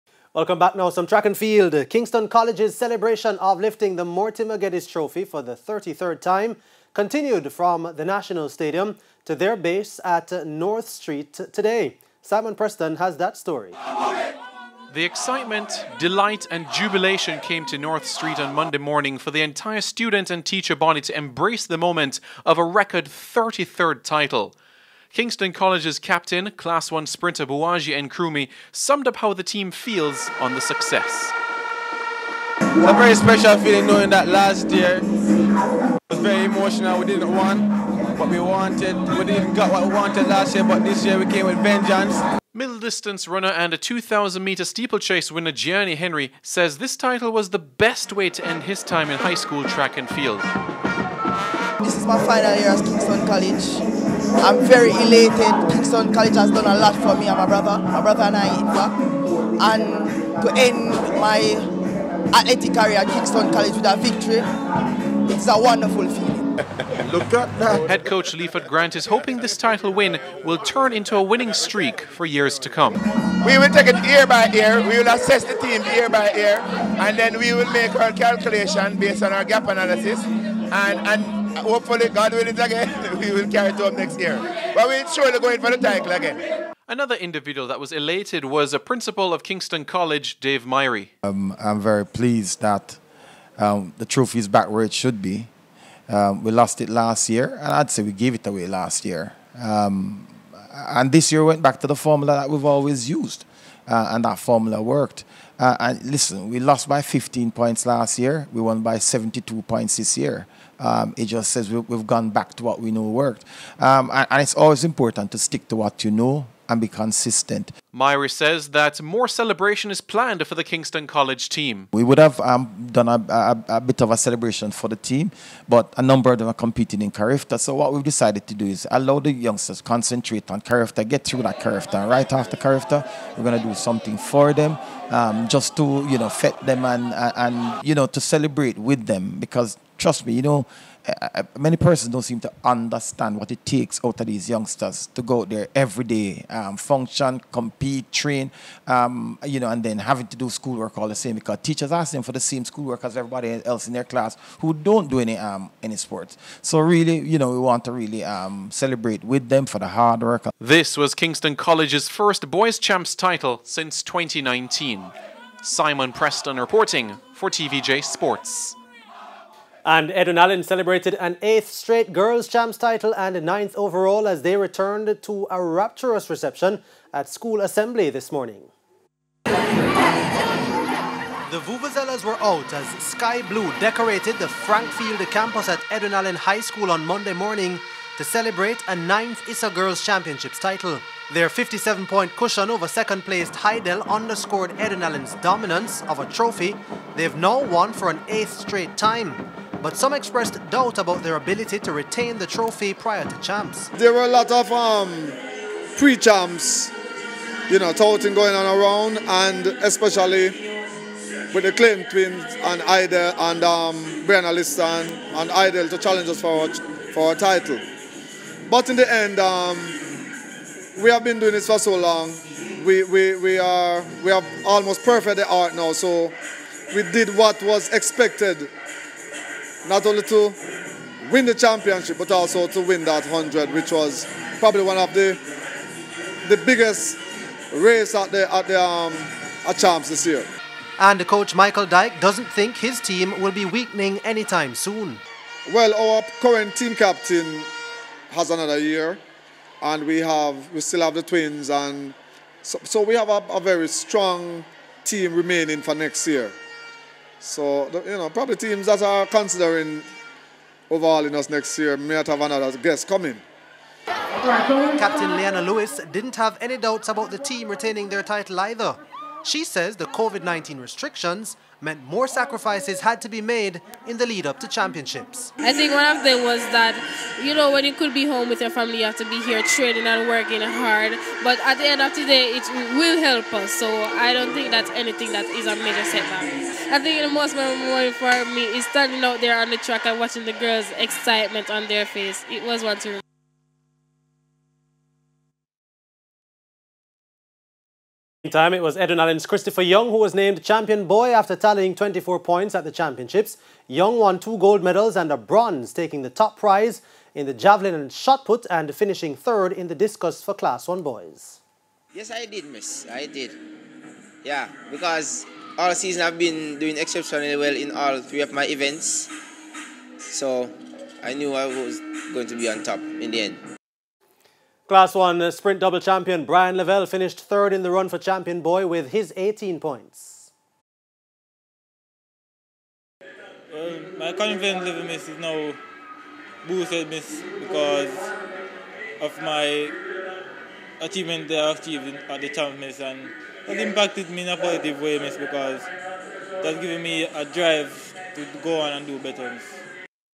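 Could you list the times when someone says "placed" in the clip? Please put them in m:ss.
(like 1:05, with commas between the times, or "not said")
3:12.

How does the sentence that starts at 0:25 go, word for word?
Kingston College's captain, Class 1 sprinter Bouwahjgie Nkrumah, summed up how the team feels on the success.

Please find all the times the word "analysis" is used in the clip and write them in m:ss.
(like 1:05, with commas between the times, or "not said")
1:19.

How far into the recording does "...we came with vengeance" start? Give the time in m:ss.
0:41.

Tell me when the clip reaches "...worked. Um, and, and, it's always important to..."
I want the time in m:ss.
1:53.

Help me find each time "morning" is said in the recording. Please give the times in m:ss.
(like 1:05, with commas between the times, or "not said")
0:18, 2:58, 3:07.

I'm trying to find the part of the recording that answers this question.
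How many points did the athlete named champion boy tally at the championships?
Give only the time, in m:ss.
5:01.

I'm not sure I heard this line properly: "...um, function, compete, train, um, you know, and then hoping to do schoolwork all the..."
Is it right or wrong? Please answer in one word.
wrong.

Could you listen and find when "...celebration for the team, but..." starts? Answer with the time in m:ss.
2:04.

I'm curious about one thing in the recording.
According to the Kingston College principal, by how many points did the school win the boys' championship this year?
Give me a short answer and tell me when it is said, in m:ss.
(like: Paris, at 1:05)
72 points, at 1:48.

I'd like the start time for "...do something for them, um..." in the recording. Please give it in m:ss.
2:13.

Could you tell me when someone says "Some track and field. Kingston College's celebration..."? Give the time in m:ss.
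0:00.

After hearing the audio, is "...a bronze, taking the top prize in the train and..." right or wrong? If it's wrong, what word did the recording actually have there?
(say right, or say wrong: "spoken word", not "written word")
wrong: "javelin", not "train".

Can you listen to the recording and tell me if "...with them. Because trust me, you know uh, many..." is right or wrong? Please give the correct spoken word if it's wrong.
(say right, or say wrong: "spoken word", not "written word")
right.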